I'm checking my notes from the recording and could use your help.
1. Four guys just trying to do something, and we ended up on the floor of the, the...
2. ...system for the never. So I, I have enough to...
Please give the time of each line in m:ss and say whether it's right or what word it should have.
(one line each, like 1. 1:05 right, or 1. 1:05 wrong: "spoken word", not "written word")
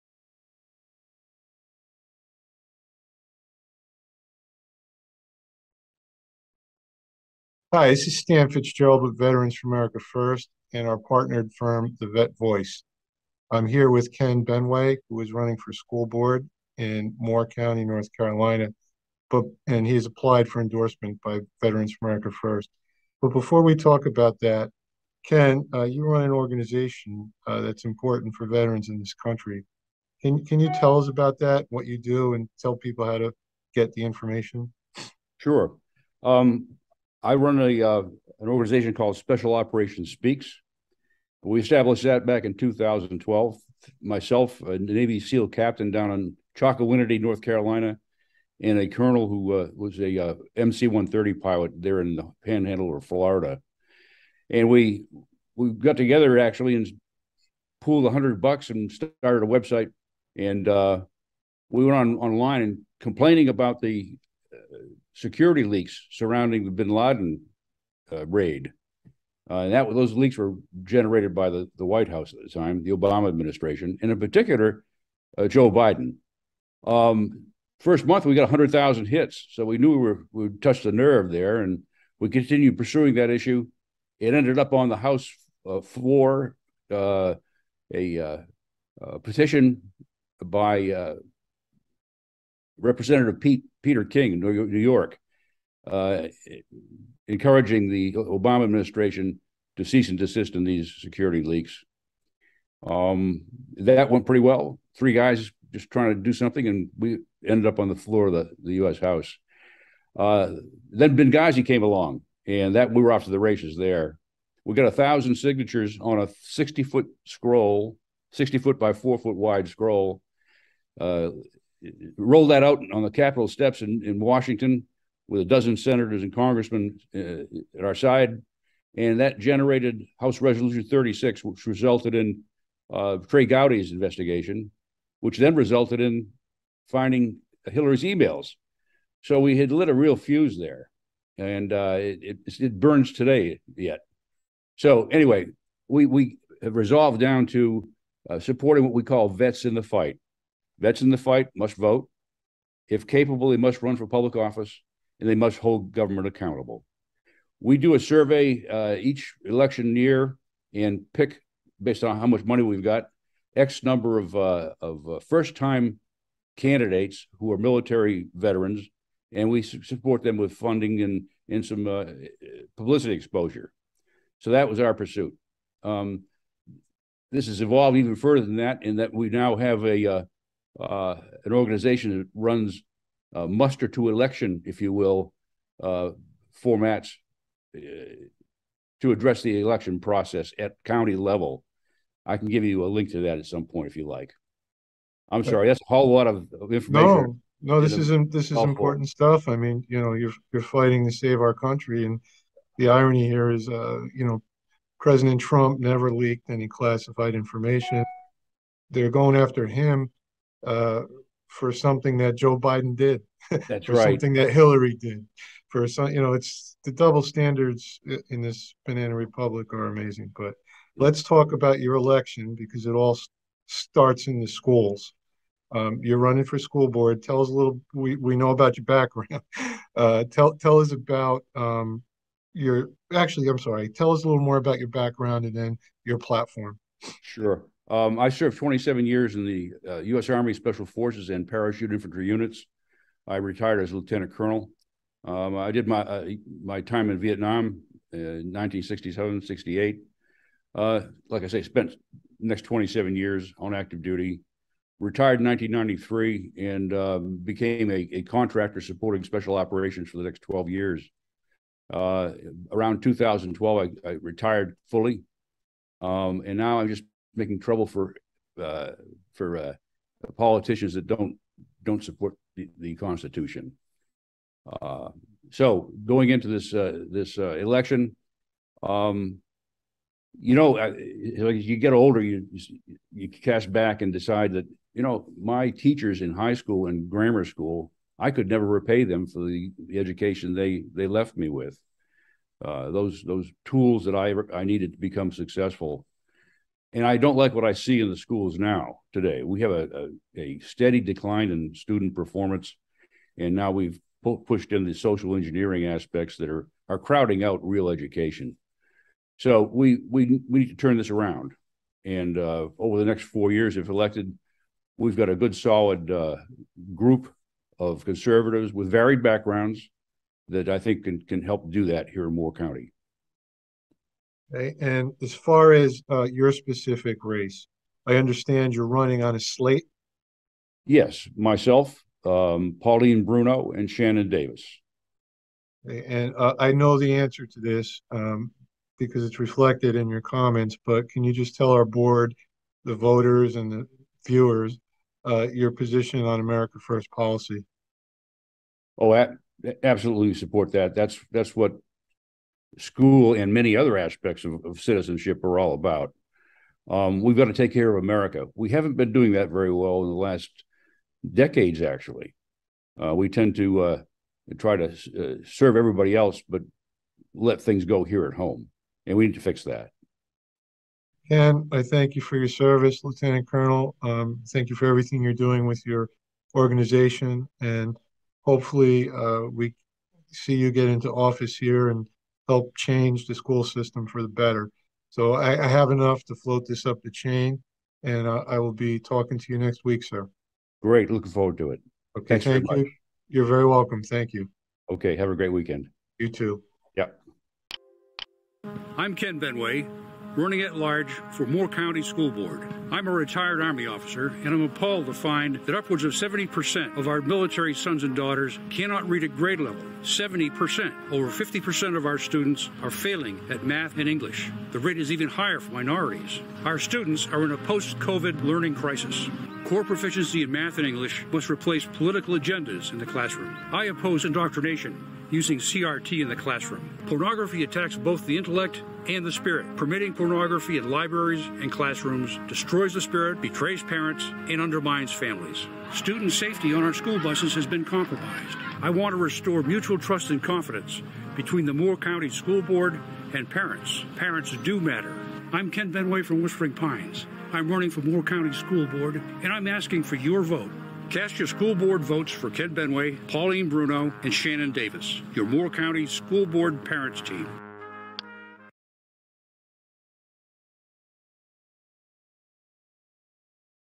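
1. 1:44 wrong: "Three", not "Four"
2. 6:23 wrong: "better", not "never".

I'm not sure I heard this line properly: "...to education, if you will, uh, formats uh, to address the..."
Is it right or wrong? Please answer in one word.
wrong.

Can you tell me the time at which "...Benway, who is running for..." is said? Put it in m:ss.
0:14.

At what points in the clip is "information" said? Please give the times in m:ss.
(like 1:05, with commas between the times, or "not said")
0:34, 3:16, 3:27.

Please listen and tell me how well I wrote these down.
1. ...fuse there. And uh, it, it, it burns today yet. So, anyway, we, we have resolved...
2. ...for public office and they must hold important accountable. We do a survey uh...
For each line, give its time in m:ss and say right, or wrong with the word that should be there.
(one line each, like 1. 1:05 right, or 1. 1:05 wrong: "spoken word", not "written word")
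1. 2:20 right
2. 2:33 wrong: "government", not "important".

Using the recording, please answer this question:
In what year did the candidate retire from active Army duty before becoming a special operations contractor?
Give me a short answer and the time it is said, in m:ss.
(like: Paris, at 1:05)
1993, at 4:15.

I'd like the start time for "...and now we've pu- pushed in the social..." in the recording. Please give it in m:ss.
5:03.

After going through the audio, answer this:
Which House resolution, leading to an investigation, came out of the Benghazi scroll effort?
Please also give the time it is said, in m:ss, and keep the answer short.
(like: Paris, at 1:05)
House Resolution 36, at 2:10.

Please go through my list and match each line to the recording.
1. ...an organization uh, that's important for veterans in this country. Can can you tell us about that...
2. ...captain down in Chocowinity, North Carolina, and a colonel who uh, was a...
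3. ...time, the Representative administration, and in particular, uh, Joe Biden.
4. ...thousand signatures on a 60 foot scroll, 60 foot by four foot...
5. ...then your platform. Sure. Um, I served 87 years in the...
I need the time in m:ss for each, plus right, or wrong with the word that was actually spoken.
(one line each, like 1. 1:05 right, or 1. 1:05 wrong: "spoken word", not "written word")
1. 0:26 right
2. 0:45 right
3. 1:12 wrong: "Obama", not "Representative"
4. 1:54 right
5. 3:55 wrong: "27", not "87".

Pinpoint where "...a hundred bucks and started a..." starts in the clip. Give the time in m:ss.
0:58.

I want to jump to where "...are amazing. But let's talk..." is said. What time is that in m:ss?
3:39.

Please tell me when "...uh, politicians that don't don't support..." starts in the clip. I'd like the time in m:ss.
4:29.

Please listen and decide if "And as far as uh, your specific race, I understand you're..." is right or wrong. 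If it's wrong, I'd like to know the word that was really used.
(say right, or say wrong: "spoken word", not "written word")
right.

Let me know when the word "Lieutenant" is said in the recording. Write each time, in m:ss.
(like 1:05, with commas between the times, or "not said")
4:03, 6:13.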